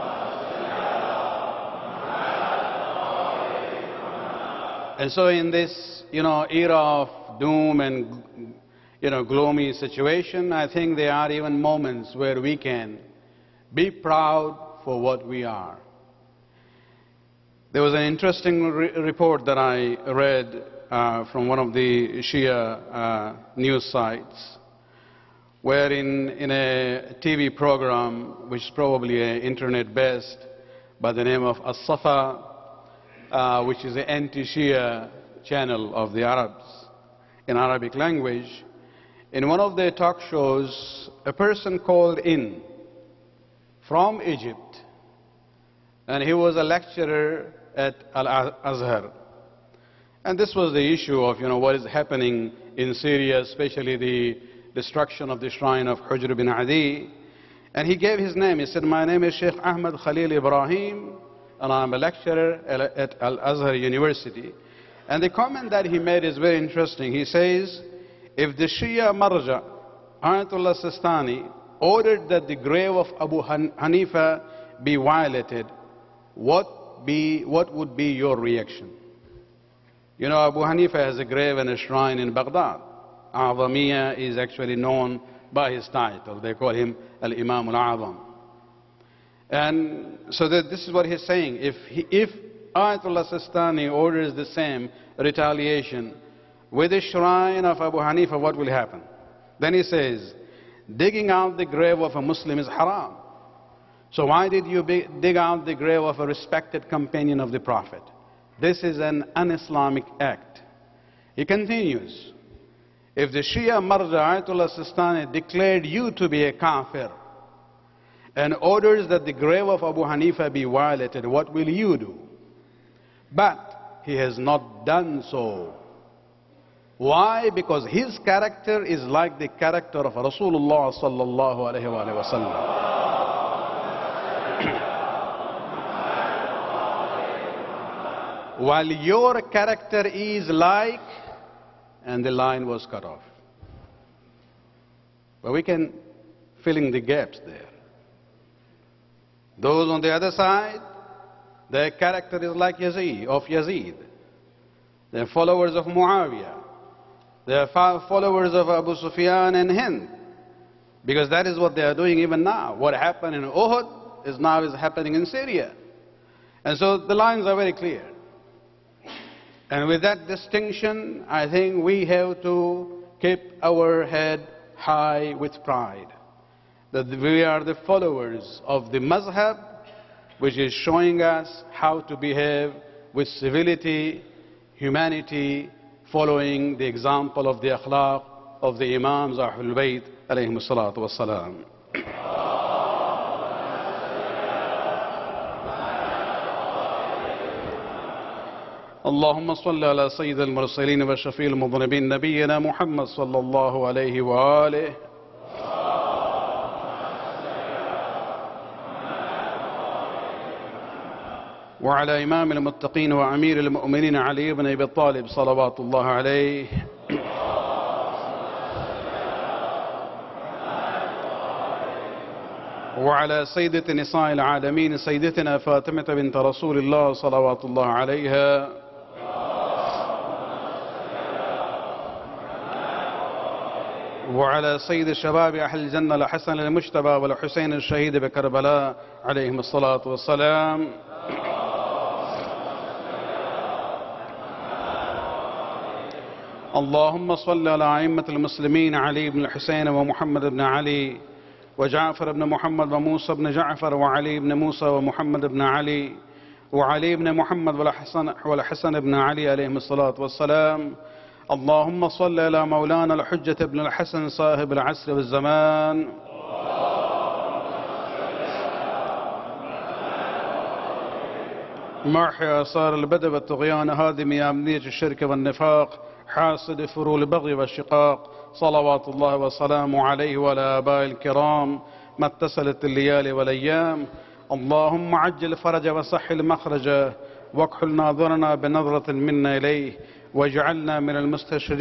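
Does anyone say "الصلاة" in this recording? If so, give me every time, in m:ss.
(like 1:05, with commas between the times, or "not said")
3:59, 4:19.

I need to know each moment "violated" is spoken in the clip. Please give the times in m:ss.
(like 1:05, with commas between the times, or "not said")
1:14, 2:00.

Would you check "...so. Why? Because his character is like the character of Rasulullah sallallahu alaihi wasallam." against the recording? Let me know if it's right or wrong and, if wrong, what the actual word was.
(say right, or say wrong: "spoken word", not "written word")
right.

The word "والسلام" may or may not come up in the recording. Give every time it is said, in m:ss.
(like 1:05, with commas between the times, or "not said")
4:00, 4:20.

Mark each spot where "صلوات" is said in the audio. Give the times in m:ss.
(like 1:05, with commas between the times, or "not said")
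3:35, 3:47, 4:38.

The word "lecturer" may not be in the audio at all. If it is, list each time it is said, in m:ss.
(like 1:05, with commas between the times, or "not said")
0:46, 1:01.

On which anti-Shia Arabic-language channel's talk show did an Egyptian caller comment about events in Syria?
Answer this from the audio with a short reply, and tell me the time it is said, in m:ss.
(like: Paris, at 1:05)
As-Safa, at 0:31.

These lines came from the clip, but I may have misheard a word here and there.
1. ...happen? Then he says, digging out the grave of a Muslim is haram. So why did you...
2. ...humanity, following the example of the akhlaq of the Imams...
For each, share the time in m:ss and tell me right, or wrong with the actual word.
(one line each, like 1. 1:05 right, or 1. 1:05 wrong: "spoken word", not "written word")
1. 1:38 right
2. 3:04 right.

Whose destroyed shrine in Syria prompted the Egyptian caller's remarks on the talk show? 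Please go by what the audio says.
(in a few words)
Hujr bin Adi.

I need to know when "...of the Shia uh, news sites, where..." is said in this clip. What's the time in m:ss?
0:21.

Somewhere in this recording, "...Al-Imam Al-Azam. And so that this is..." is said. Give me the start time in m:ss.
1:27.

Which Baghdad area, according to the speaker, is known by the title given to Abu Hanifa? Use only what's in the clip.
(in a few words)
Azamiya.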